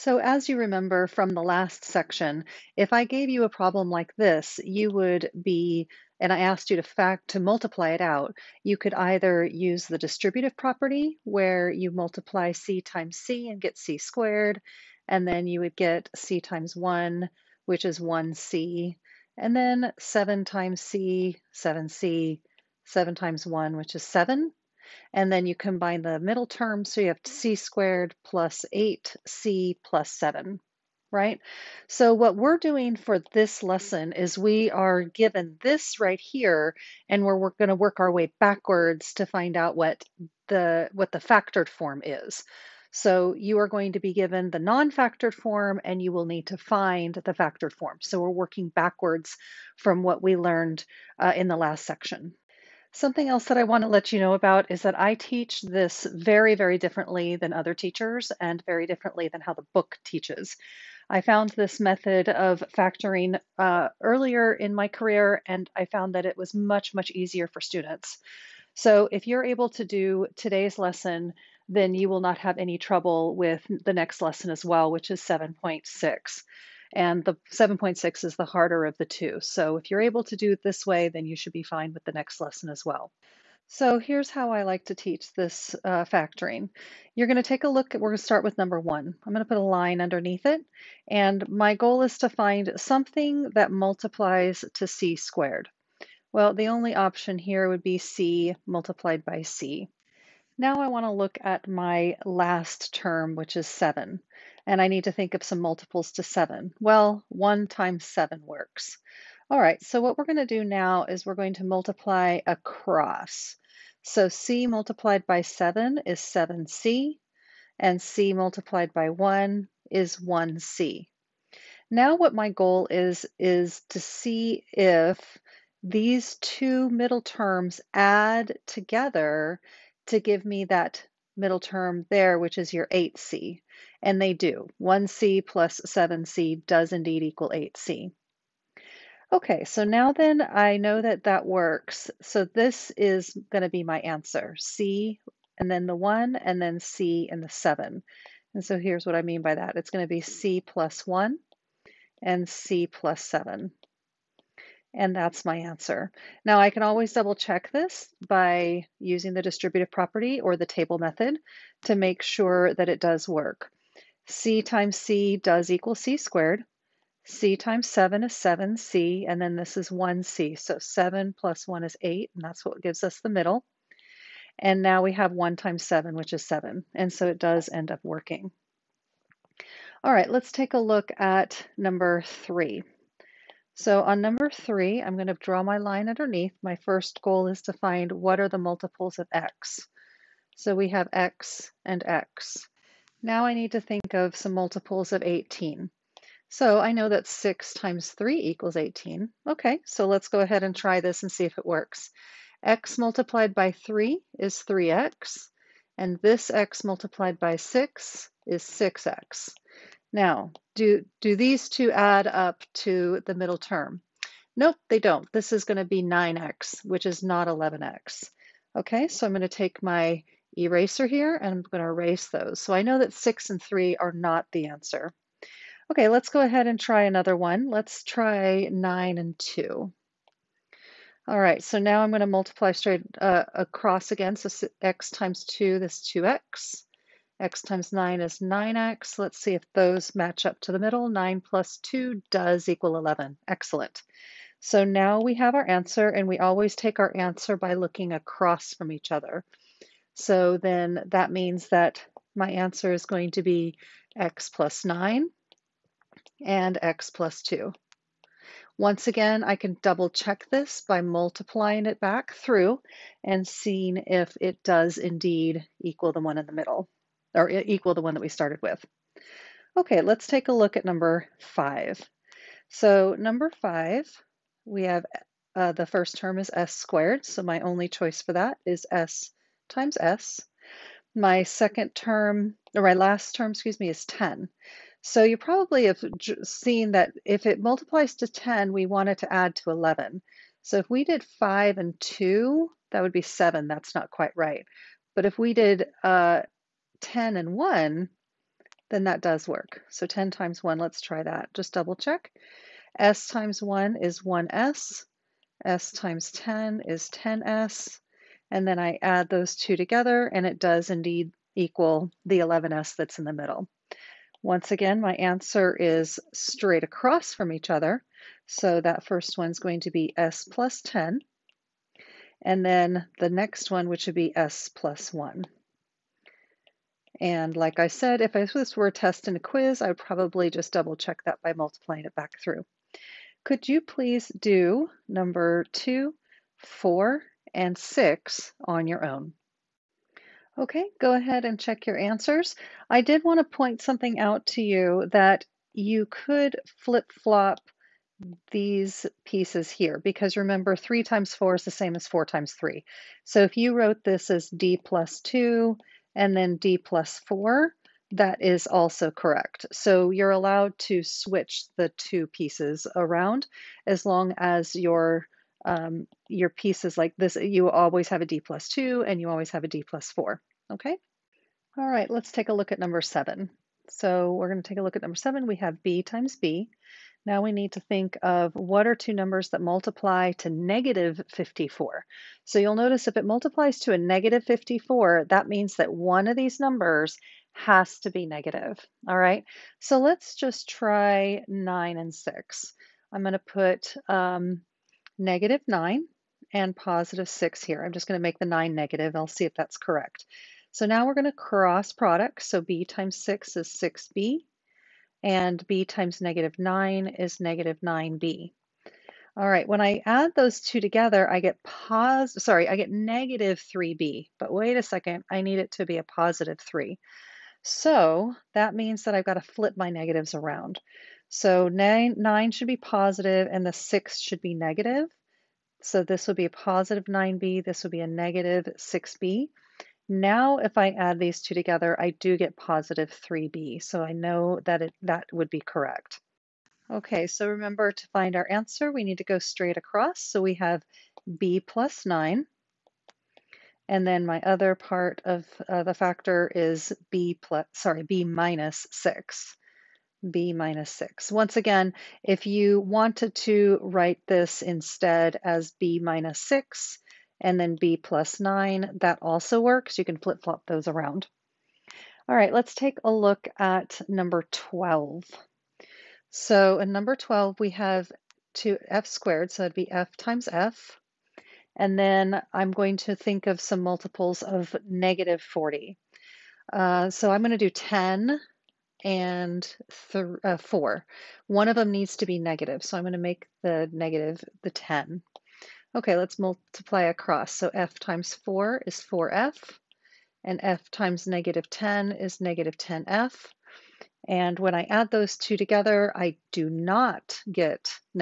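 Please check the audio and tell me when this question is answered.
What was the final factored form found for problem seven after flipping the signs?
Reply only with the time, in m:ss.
7:21.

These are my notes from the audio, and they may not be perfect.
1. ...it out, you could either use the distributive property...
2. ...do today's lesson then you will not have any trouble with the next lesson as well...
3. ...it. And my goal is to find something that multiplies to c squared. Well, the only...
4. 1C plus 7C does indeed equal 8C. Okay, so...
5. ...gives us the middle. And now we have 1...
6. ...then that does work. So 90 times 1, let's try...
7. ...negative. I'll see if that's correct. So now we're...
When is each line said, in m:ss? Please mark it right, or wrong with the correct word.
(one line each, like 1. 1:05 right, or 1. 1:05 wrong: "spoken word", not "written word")
1. 0:07 right
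2. 1:09 right
3. 1:30 right
4. 2:14 right
5. 2:52 right
6. 4:58 wrong: "10", not "90"
7. 6:38 right.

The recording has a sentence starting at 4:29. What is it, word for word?
Okay, let's take a look at number five.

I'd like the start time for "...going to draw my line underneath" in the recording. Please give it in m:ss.
3:05.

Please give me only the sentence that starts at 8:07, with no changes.
So f times 4 is 4f, and f times negative 10 is negative 10f.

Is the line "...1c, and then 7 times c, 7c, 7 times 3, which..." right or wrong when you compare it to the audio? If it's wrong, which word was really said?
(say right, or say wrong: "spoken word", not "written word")
wrong: "1", not "3".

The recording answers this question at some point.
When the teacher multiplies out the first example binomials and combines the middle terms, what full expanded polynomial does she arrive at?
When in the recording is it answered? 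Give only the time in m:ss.
0:27.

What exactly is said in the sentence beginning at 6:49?
All right, when I add those two together, I get pos sorry, I get negative 3b.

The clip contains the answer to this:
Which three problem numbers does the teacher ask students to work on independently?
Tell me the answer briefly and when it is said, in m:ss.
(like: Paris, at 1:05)
2, 4, and 6, at 5:35.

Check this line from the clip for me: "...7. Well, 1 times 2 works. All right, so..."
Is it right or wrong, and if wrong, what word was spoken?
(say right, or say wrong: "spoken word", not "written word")
wrong: "7", not "2".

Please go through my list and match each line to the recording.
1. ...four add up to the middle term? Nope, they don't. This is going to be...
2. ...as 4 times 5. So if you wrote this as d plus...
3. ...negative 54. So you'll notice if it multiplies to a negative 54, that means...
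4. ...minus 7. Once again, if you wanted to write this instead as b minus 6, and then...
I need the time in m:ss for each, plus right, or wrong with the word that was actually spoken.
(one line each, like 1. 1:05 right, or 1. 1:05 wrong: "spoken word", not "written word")
1. 3:31 wrong: "two", not "four"
2. 5:51 wrong: "3", not "5"
3. 6:20 right
4. 7:30 wrong: "6", not "7".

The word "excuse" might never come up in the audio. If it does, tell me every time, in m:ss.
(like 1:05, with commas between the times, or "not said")
4:43.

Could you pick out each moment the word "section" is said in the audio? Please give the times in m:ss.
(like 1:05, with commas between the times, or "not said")
0:01, 0:51.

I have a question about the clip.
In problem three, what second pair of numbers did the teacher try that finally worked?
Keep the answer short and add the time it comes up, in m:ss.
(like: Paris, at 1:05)
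9 and 2, at 3:48.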